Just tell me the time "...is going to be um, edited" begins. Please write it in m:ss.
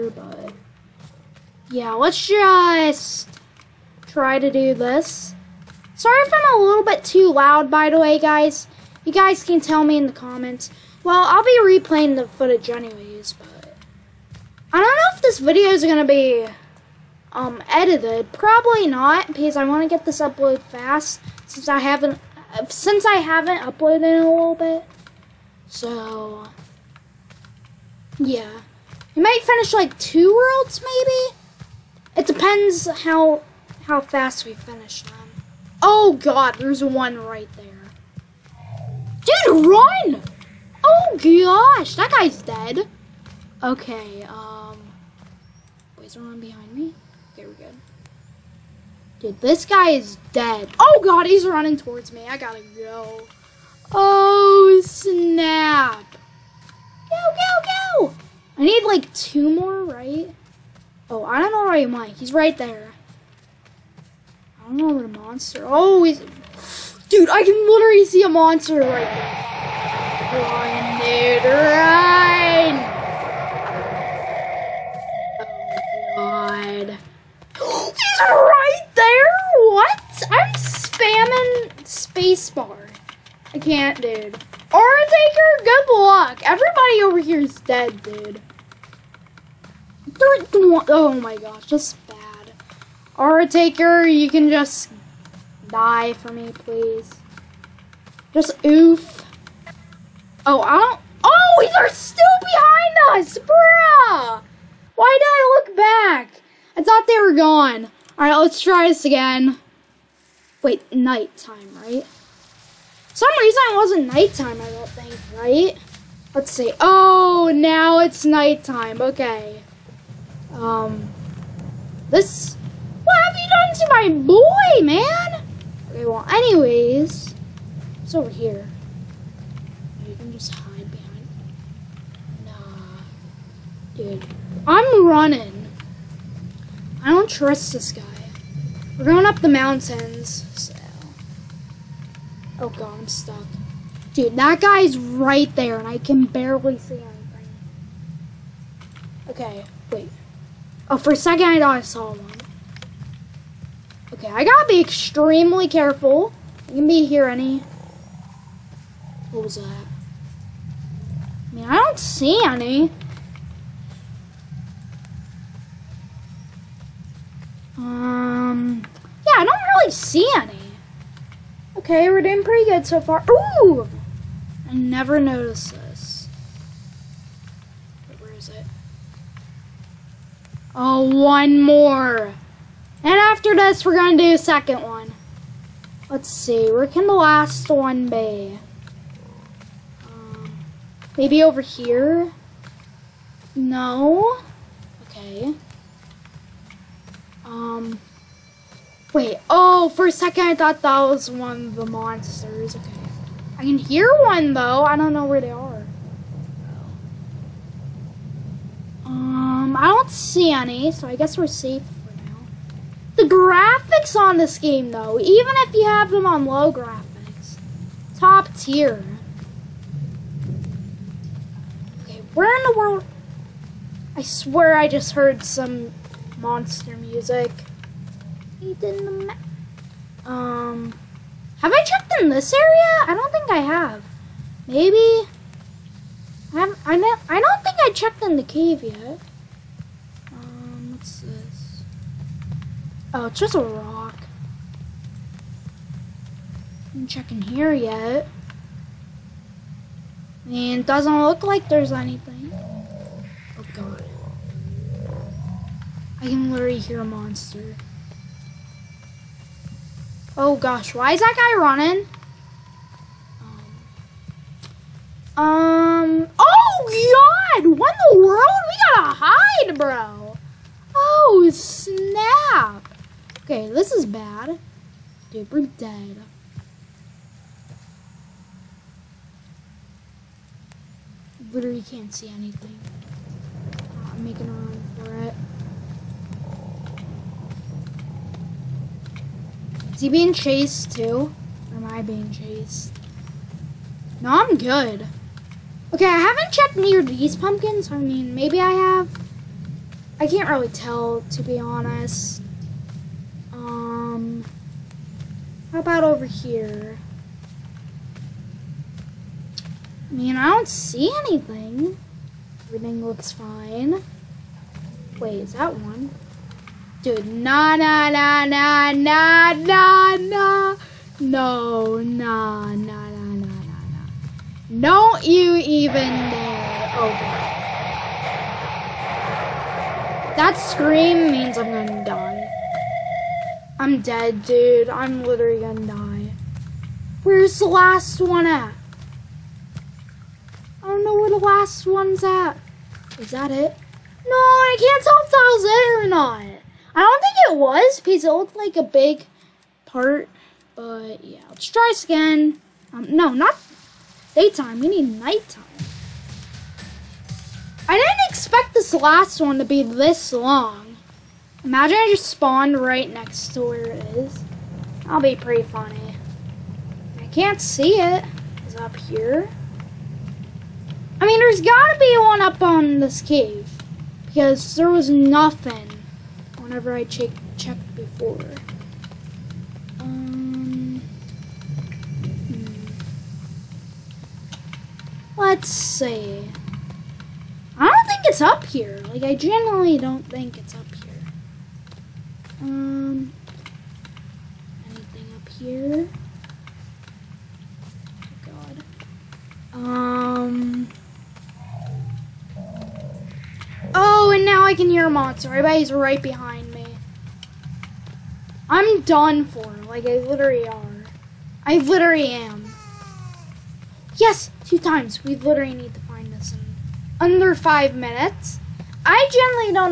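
0:15.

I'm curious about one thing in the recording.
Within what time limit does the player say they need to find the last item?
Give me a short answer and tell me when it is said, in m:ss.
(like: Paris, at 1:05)
5 minutes, at 6:57.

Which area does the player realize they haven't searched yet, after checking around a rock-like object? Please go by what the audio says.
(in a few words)
The cave.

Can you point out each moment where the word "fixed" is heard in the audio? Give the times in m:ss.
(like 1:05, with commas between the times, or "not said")
not said.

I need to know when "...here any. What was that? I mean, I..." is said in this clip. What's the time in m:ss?
2:37.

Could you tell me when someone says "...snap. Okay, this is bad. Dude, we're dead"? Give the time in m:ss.
4:31.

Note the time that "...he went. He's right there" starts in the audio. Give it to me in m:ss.
1:01.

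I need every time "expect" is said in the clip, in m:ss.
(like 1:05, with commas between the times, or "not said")
5:58.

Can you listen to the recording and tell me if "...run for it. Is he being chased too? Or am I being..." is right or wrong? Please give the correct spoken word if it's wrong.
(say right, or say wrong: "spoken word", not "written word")
right.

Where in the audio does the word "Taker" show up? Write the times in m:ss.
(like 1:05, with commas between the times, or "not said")
1:25, 1:33.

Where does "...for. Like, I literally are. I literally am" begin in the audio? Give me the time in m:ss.
6:49.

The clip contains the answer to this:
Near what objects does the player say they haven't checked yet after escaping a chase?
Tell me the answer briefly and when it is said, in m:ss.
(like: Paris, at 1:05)
Pumpkins, at 4:57.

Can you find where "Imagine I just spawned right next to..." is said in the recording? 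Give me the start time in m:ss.
6:01.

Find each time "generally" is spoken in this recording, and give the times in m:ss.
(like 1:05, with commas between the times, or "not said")
6:29, 6:59.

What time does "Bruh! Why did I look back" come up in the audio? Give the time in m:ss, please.
1:43.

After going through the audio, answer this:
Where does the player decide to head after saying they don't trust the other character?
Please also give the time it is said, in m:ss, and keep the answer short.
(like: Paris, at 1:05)
Up the mountains, at 2:19.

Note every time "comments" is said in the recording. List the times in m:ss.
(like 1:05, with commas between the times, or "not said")
0:10.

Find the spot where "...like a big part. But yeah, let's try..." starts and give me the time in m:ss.
5:48.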